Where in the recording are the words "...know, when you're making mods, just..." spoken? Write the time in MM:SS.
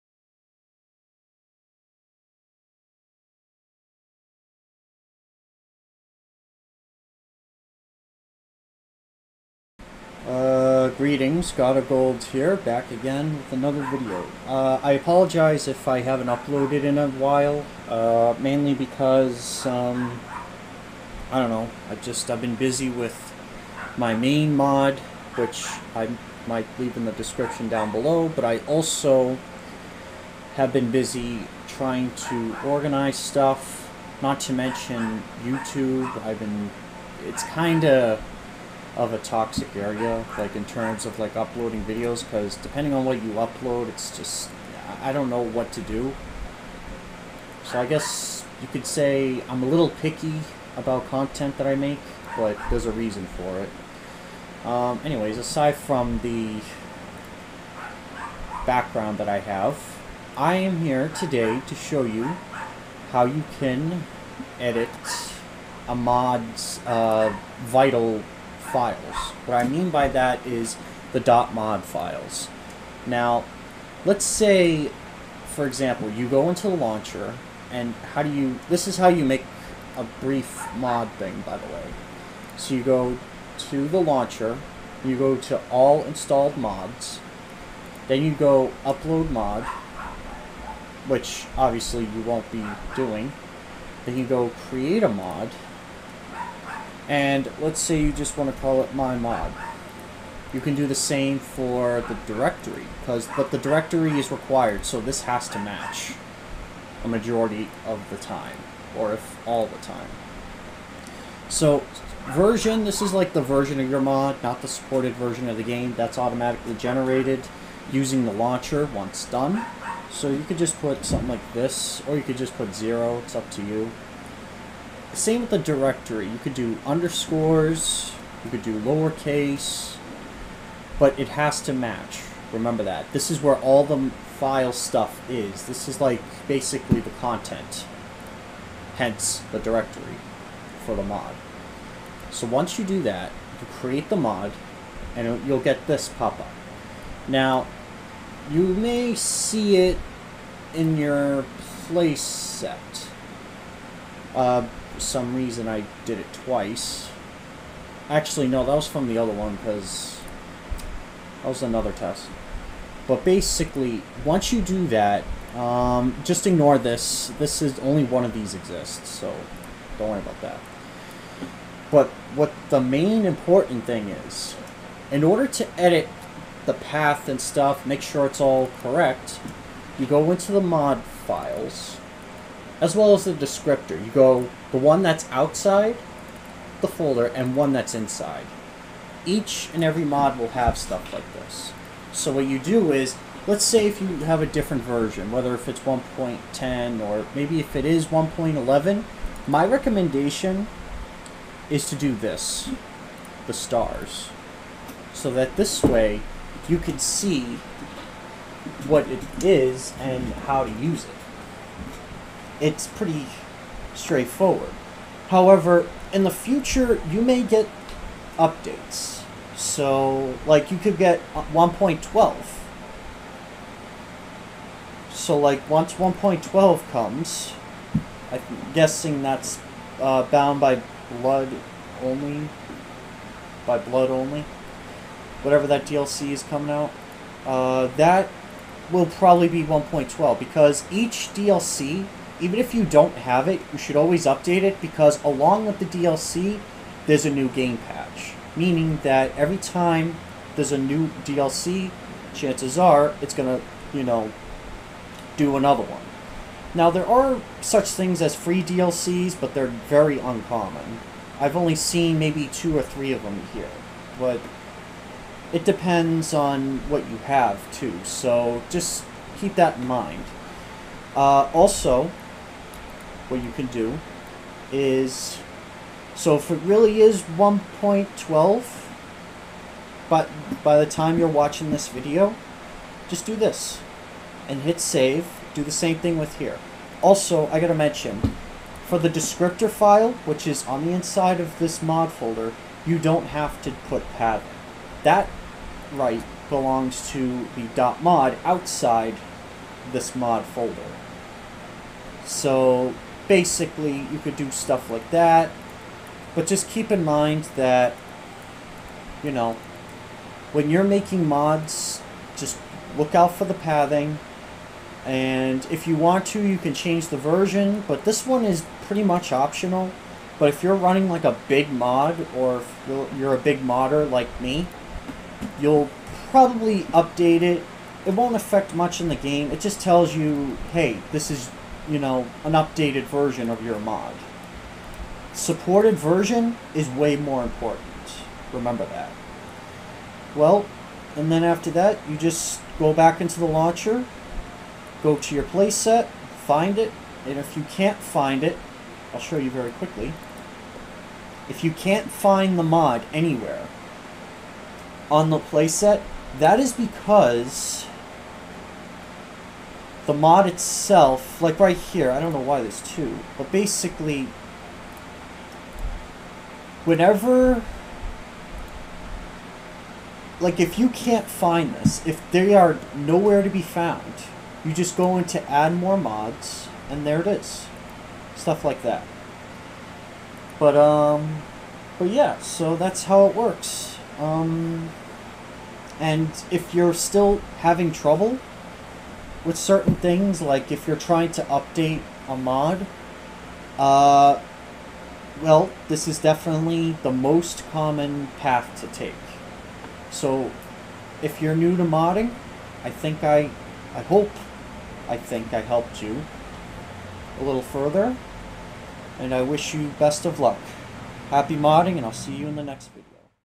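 05:09.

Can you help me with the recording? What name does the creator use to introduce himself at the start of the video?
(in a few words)
God of Gold.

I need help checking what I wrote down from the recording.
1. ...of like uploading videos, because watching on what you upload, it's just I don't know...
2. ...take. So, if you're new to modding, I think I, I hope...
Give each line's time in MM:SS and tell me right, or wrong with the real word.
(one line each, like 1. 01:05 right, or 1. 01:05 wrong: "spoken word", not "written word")
1. 00:41 wrong: "depending", not "watching"
2. 06:38 right.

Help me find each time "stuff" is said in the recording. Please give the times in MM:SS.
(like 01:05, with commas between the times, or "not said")
00:33, 02:14, 02:57, 03:10, 05:04, 06:18.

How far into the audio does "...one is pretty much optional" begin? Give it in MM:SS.
05:18.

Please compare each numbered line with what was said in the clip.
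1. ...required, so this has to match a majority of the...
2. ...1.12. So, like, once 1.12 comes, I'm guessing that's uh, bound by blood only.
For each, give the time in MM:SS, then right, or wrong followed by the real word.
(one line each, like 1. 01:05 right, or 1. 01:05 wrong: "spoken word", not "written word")
1. 01:44 right
2. 03:41 right.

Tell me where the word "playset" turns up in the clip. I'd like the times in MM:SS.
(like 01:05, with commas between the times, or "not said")
02:31, 05:45, 05:55.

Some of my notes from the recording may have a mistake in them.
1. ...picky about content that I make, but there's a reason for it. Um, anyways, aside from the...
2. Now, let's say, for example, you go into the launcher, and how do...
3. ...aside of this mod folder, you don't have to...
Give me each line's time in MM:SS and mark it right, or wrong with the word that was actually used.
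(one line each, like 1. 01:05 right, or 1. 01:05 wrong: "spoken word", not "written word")
1. 00:49 right
2. 01:13 right
3. 04:50 wrong: "inside", not "aside".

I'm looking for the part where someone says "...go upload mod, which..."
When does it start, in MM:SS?
01:28.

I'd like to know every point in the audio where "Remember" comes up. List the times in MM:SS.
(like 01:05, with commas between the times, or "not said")
02:12, 05:38.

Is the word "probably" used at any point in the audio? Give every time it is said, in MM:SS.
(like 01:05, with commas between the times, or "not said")
03:59, 05:26.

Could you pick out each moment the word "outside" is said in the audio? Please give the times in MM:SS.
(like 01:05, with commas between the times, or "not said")
03:05, 04:58.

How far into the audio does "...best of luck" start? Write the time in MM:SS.
06:49.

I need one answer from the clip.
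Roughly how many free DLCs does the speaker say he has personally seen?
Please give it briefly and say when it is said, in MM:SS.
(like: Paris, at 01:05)
2 or 3, at 04:22.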